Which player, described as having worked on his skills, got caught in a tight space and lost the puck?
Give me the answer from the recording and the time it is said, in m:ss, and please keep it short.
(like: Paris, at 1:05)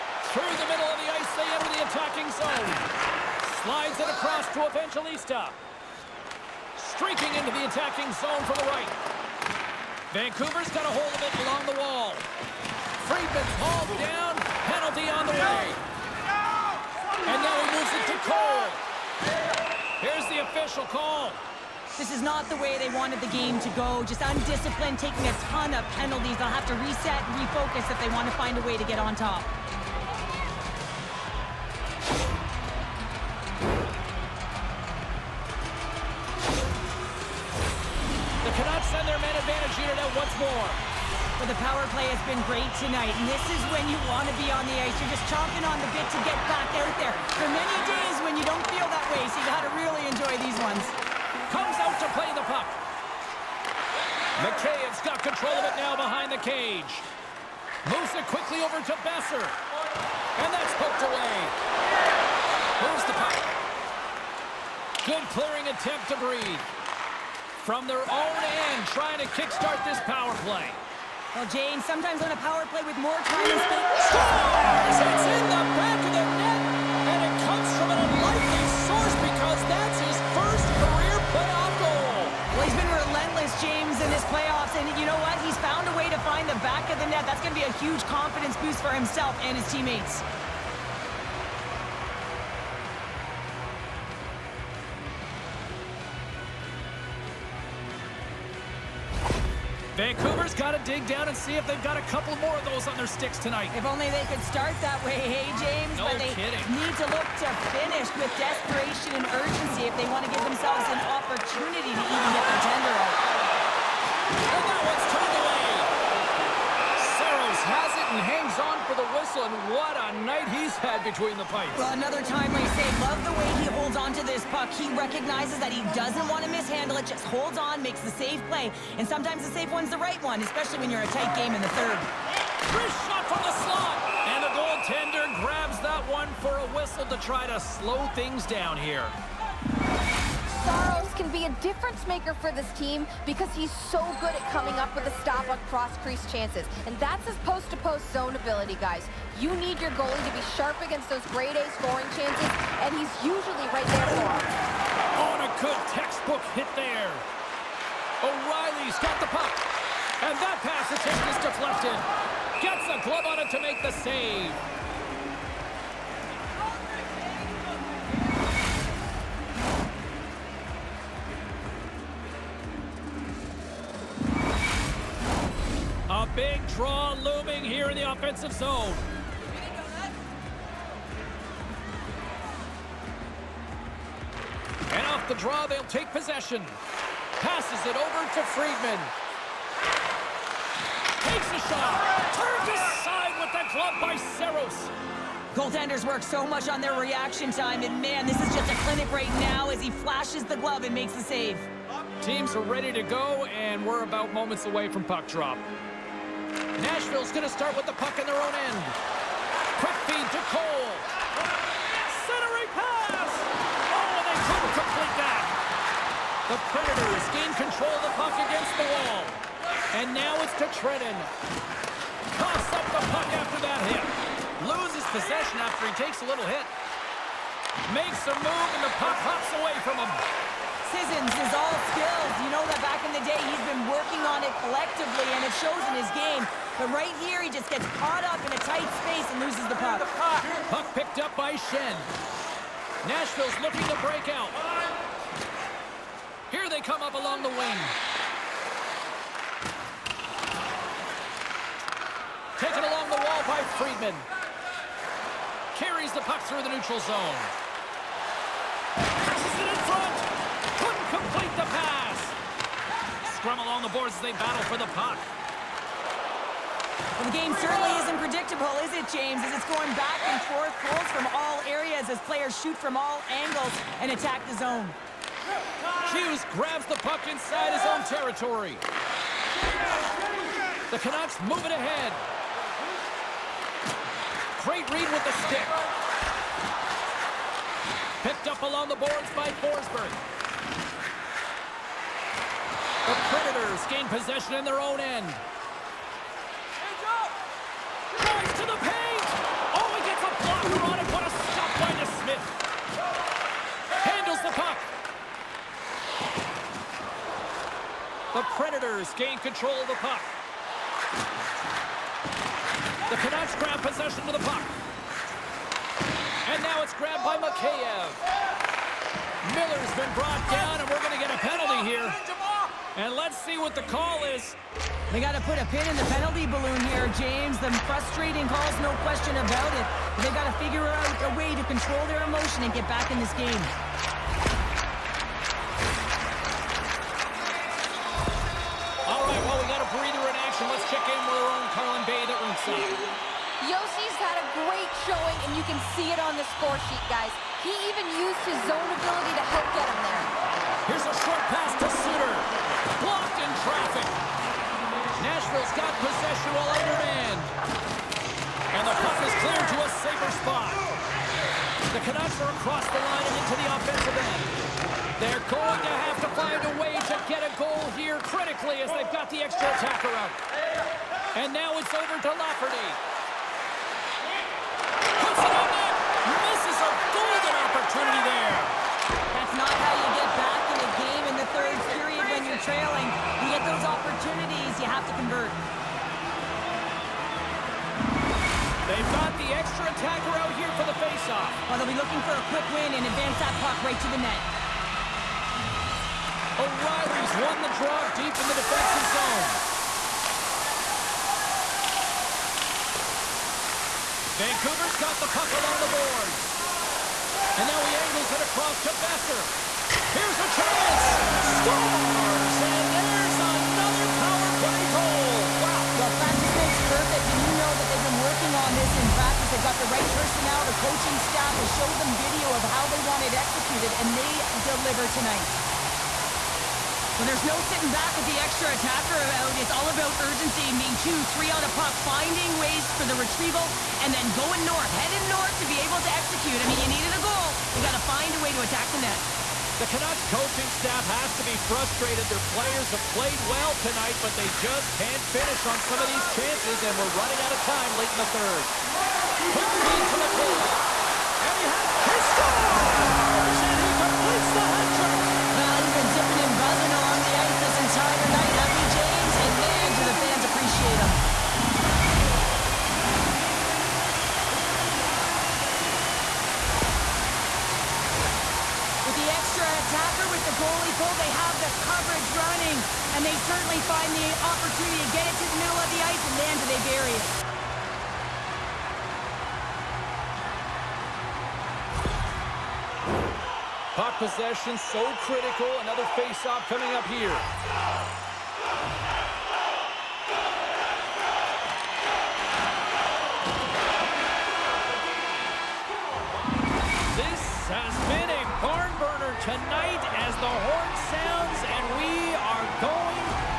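Sissons, at 3:50.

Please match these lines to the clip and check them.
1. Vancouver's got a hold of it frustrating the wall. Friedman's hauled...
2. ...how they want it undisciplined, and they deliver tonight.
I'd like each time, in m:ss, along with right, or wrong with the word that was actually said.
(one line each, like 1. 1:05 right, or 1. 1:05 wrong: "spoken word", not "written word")
1. 0:10 wrong: "along", not "frustrating"
2. 7:02 wrong: "executed", not "undisciplined".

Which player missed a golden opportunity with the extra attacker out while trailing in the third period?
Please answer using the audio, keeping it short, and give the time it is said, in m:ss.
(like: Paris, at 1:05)
Lafferty, at 6:12.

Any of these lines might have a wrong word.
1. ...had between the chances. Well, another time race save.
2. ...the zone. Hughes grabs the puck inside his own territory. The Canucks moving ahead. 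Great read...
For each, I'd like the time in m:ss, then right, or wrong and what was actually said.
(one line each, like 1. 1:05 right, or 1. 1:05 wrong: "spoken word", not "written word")
1. 2:00 wrong: "pipes", not "chances"
2. 4:34 right.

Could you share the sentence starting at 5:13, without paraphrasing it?
The Canucks grab possession of the puck.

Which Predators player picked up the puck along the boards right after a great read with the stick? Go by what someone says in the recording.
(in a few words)
Forsberg.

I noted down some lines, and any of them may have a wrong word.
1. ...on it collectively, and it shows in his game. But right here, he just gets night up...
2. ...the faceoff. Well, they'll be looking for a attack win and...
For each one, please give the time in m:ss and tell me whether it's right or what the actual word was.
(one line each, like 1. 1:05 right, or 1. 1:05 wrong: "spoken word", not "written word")
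1. 3:54 wrong: "caught", not "night"
2. 6:30 wrong: "quick", not "attack".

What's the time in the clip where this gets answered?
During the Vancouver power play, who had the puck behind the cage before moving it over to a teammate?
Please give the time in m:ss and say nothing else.
0:54.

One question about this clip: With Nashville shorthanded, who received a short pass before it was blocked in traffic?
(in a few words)
Suter.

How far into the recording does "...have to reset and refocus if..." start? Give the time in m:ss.
0:26.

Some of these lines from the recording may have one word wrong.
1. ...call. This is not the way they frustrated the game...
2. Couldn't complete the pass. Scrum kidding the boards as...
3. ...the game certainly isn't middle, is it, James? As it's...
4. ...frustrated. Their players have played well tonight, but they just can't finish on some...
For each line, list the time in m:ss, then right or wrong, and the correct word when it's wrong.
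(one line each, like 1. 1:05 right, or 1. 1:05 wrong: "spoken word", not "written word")
1. 0:20 wrong: "wanted", not "frustrated"
2. 4:20 wrong: "along", not "kidding"
3. 4:27 wrong: "predictable", not "middle"
4. 7:21 right.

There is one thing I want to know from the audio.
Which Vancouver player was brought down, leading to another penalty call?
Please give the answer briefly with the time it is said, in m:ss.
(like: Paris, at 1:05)
Miller, at 5:19.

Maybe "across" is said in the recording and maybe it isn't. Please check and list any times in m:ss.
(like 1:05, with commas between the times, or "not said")
0:04, 6:02, 6:48.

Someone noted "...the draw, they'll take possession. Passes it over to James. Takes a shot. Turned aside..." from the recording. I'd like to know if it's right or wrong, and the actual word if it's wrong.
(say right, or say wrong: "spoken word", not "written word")
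wrong: "Friedman", not "James".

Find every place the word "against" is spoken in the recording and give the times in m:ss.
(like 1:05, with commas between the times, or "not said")
2:30, 3:38.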